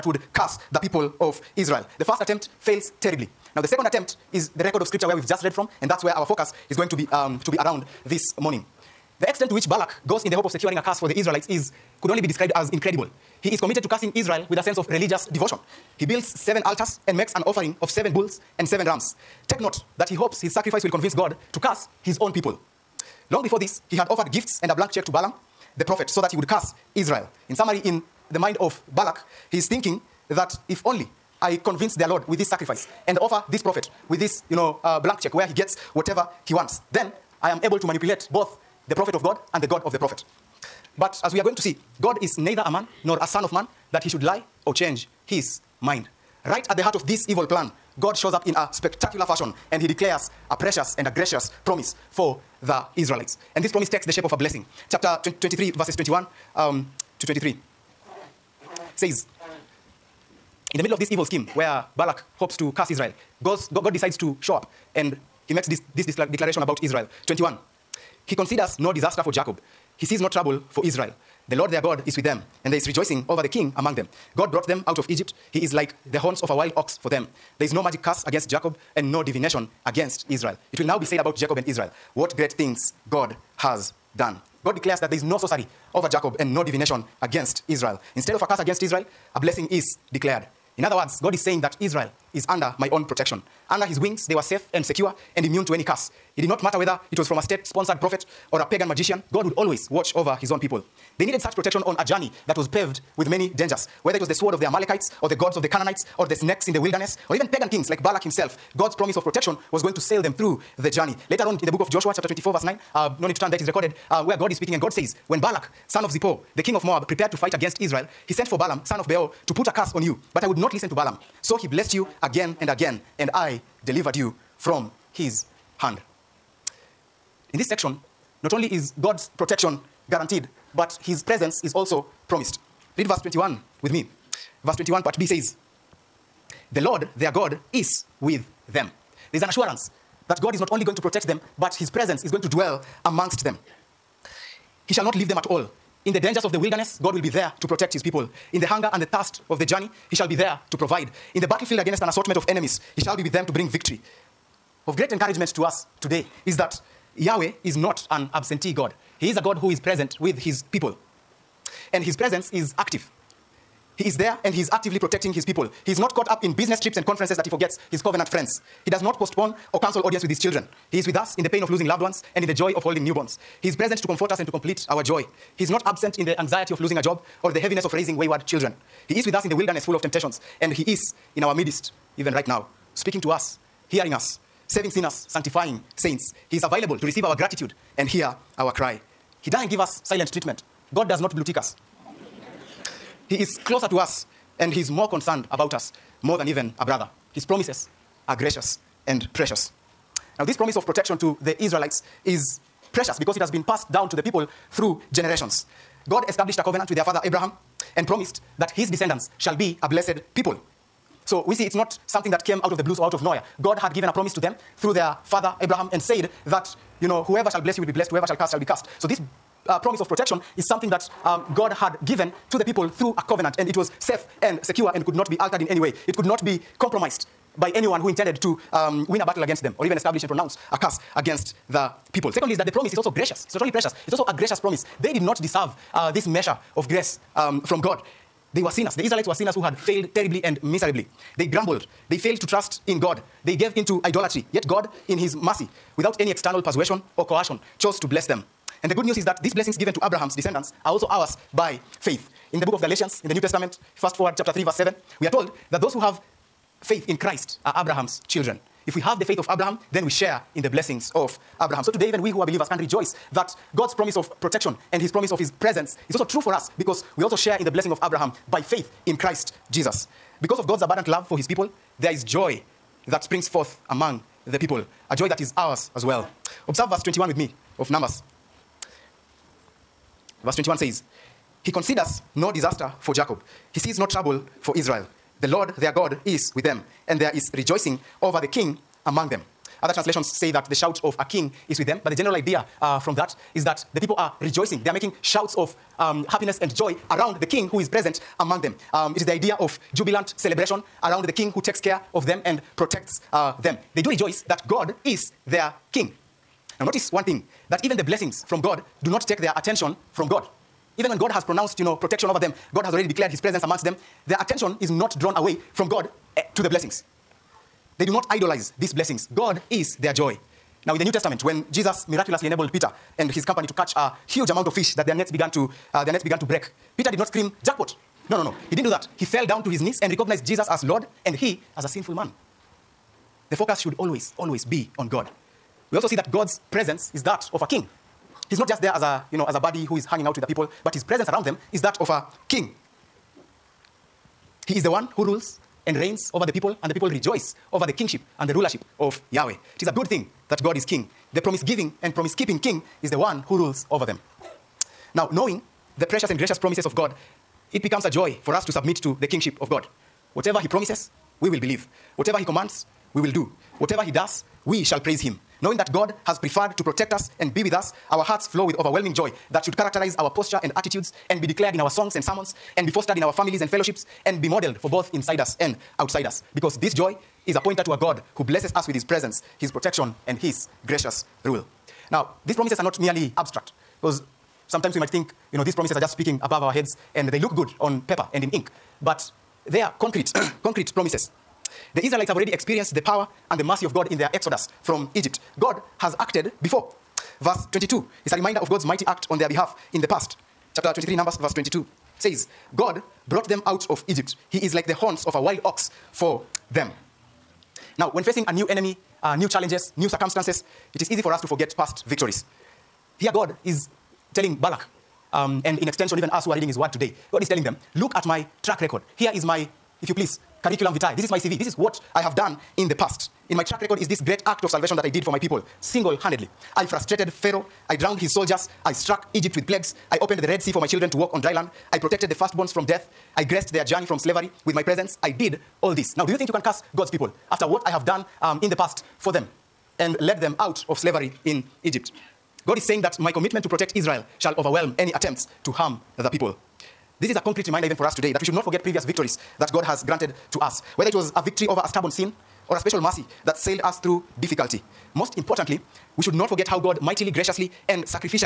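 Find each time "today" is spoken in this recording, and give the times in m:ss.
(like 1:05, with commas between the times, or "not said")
2:36, 4:21, 6:56, 7:28.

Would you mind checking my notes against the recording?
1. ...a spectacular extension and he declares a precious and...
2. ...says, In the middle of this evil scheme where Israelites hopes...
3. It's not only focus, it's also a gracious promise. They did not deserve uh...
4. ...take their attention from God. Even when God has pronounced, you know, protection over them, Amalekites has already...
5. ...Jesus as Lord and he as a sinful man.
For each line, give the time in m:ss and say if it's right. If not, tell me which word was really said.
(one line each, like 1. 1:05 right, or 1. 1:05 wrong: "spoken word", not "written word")
1. 0:48 wrong: "fashion", not "extension"
2. 0:58 wrong: "Balak", not "Israelites"
3. 3:53 wrong: "precious", not "focus"
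4. 5:09 wrong: "God", not "Amalekites"
5. 5:30 right.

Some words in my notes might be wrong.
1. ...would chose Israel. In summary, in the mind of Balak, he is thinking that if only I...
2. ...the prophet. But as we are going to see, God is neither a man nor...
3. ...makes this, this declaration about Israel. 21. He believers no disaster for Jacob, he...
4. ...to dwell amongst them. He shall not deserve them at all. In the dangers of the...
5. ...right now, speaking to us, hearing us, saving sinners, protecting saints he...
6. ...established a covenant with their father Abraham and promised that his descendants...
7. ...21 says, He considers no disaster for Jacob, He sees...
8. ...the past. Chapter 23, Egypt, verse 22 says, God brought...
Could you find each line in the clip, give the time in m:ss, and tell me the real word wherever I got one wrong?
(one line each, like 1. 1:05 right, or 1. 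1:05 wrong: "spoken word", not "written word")
1. 0:26 wrong: "curse", not "chose"
2. 0:39 right
3. 1:05 wrong: "considers", not "believers"
4. 2:22 wrong: "leave", not "deserve"
5. 3:02 wrong: "sanctifying", not "protecting"
6. 3:26 right
7. 4:40 right
8. 6:40 wrong: "Numbers", not "Egypt".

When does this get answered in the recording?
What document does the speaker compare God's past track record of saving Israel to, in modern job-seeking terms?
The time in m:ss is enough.
7:00.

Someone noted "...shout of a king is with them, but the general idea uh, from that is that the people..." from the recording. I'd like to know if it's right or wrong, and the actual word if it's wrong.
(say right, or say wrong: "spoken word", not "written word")
right.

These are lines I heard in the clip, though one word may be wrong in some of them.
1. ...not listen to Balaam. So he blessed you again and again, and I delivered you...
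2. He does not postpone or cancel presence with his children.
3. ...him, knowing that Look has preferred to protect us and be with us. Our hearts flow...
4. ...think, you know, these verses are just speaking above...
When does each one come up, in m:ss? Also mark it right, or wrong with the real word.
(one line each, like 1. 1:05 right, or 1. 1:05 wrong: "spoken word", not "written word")
1. 2:00 right
2. 2:48 wrong: "audience", not "presence"
3. 6:05 wrong: "God", not "Look"
4. 6:25 wrong: "promises", not "verses".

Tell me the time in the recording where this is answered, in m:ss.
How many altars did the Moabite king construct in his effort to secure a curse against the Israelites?
0:16.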